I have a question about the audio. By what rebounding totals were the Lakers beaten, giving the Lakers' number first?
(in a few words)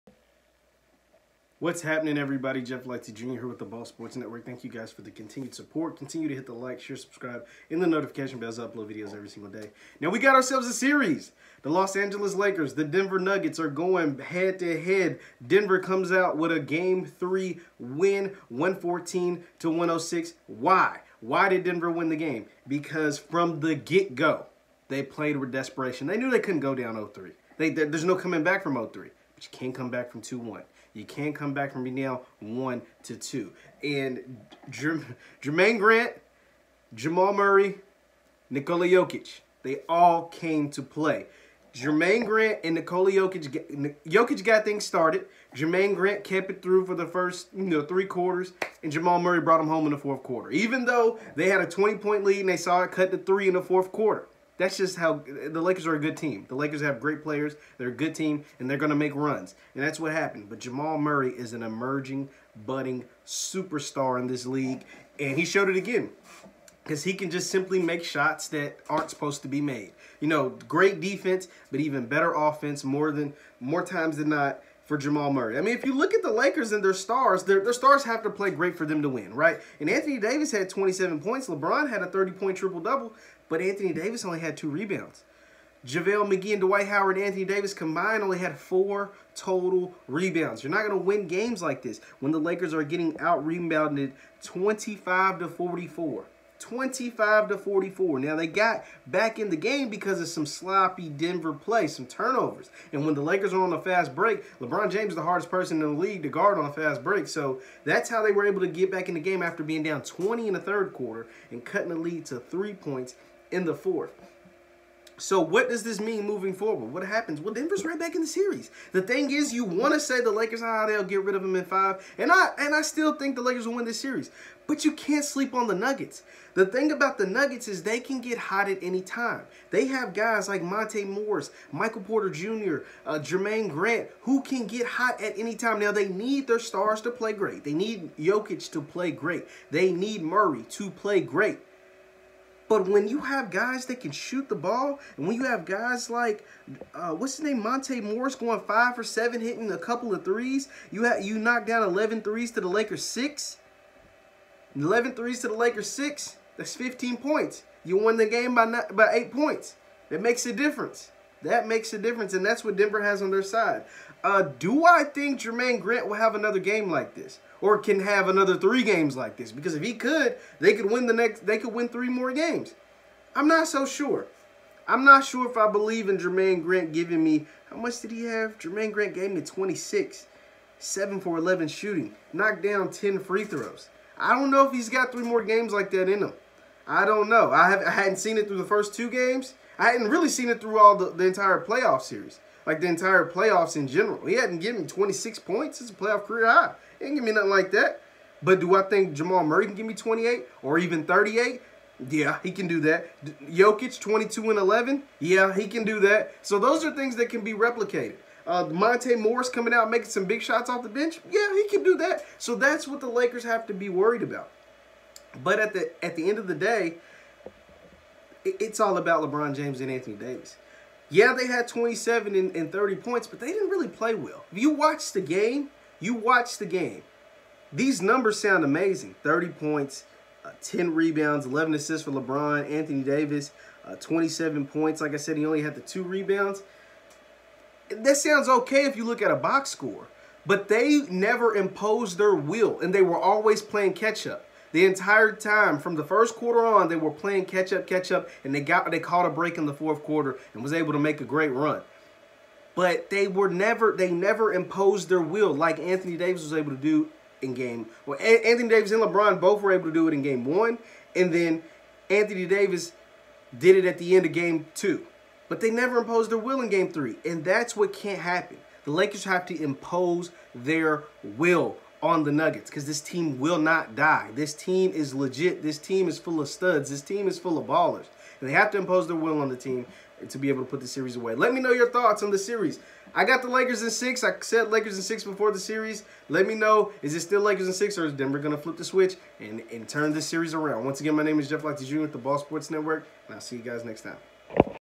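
25 to 44.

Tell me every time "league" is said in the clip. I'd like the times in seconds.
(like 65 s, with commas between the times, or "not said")
64 s, 105 s.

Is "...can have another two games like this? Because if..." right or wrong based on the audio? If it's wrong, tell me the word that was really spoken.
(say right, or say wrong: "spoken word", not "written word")
wrong: "three", not "two".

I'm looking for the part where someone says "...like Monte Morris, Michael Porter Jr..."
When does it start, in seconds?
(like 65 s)
130 s.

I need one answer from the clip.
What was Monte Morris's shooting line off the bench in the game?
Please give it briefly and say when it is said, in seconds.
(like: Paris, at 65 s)
5 for 7, at 148 s.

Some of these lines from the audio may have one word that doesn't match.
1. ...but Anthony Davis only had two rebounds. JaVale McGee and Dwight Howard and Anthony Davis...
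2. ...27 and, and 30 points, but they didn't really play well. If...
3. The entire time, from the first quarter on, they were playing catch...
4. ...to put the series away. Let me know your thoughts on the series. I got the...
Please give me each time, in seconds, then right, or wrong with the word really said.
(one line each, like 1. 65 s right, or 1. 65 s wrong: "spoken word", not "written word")
1. 83 s right
2. 221 s right
3. 244 s right
4. 280 s right.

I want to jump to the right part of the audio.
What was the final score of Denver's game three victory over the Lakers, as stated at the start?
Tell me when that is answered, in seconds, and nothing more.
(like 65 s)
18 s.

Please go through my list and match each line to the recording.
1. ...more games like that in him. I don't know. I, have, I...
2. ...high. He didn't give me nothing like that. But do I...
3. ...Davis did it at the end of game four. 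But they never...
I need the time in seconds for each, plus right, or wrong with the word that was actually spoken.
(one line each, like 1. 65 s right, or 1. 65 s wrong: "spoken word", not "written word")
1. 185 s right
2. 196 s right
3. 262 s wrong: "two", not "four".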